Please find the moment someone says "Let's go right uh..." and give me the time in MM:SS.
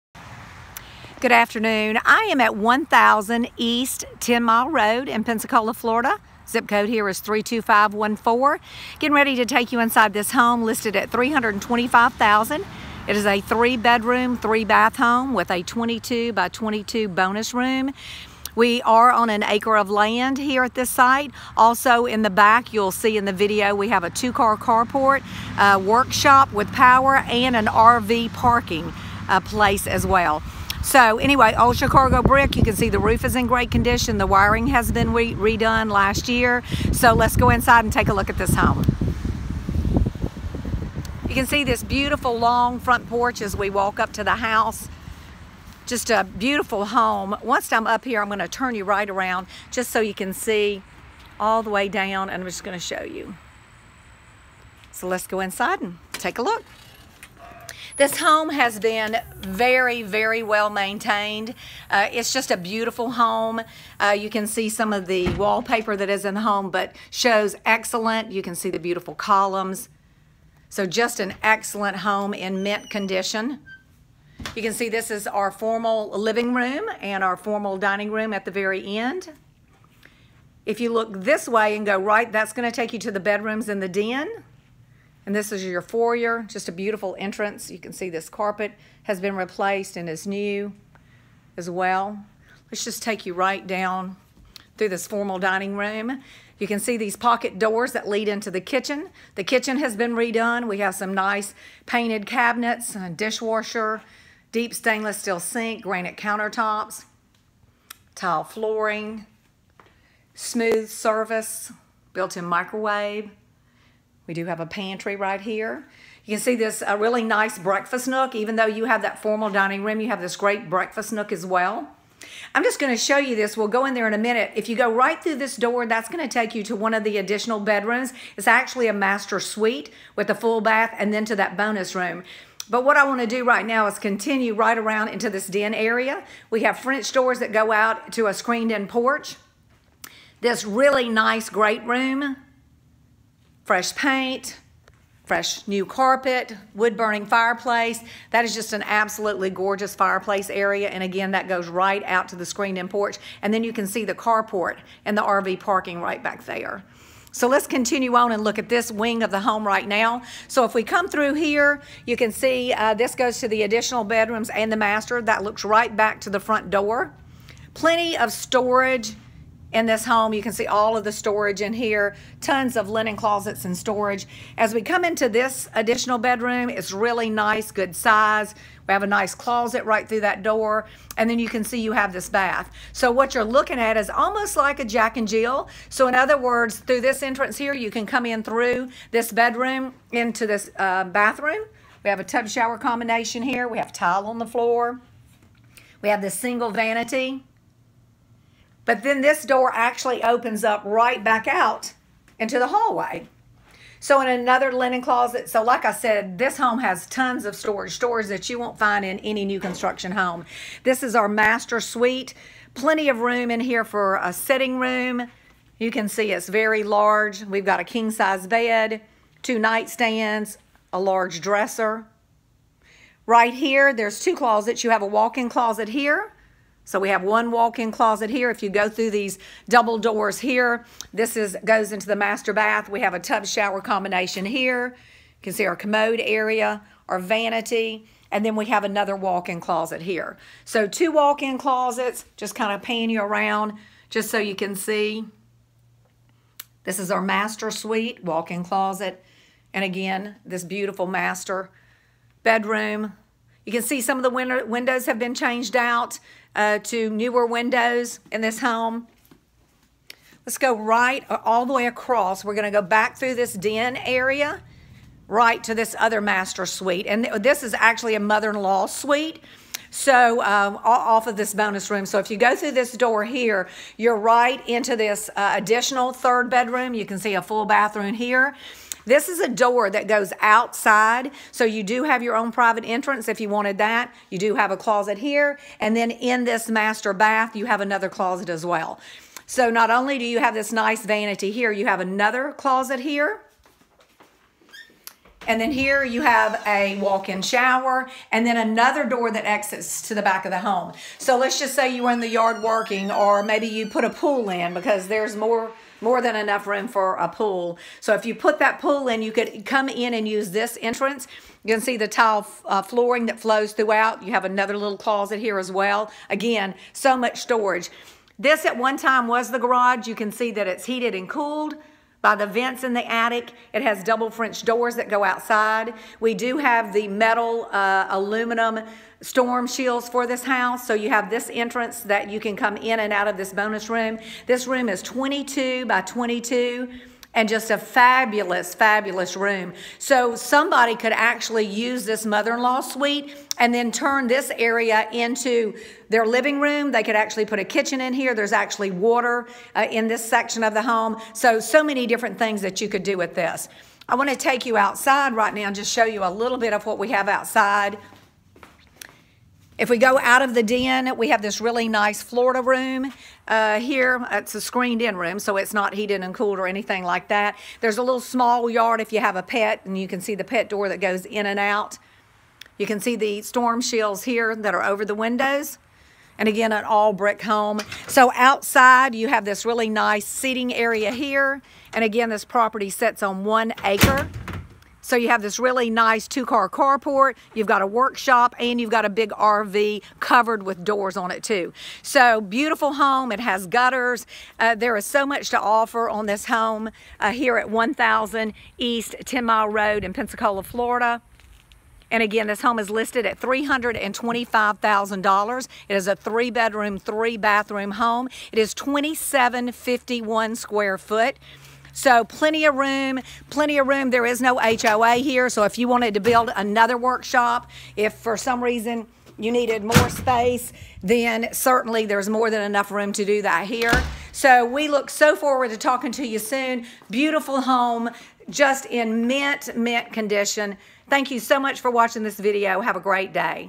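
04:20.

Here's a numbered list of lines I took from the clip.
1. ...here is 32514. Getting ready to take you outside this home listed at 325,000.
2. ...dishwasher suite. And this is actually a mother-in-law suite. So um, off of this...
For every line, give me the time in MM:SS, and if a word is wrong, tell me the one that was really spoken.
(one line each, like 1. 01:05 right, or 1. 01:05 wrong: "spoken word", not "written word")
1. 00:06 wrong: "inside", not "outside"
2. 04:26 wrong: "master", not "dishwasher".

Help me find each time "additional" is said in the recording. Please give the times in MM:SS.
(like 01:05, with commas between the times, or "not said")
02:07, 02:43, 02:55, 04:35.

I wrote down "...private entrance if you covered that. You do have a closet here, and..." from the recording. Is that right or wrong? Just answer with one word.
wrong.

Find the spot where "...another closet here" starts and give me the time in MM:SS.
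04:51.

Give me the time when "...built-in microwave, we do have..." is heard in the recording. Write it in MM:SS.
01:52.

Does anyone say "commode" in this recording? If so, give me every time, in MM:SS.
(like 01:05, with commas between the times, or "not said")
03:55.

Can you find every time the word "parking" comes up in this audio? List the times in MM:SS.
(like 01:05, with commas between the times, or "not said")
00:28, 02:35.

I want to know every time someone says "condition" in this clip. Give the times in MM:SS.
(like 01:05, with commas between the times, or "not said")
00:33, 01:12, 07:10.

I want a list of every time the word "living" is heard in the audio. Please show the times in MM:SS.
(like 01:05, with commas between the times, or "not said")
01:16, 05:46.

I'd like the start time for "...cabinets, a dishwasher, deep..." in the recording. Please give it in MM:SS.
01:42.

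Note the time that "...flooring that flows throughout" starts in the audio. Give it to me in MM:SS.
05:12.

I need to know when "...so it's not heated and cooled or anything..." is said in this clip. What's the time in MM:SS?
06:05.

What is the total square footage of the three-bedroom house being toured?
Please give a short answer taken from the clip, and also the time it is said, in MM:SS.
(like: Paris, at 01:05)
2751 square feet, at 06:48.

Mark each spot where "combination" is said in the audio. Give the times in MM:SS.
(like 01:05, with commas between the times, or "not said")
03:12, 03:53.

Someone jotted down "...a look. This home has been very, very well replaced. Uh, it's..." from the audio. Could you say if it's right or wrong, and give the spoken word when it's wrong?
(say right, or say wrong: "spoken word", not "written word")
wrong: "maintained", not "replaced".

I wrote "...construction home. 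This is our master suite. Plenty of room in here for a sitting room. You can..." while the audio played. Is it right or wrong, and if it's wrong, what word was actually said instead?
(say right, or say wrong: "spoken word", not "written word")
right.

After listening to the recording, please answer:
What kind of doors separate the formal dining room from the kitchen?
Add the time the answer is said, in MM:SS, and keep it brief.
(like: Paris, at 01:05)
Pocket doors, at 01:37.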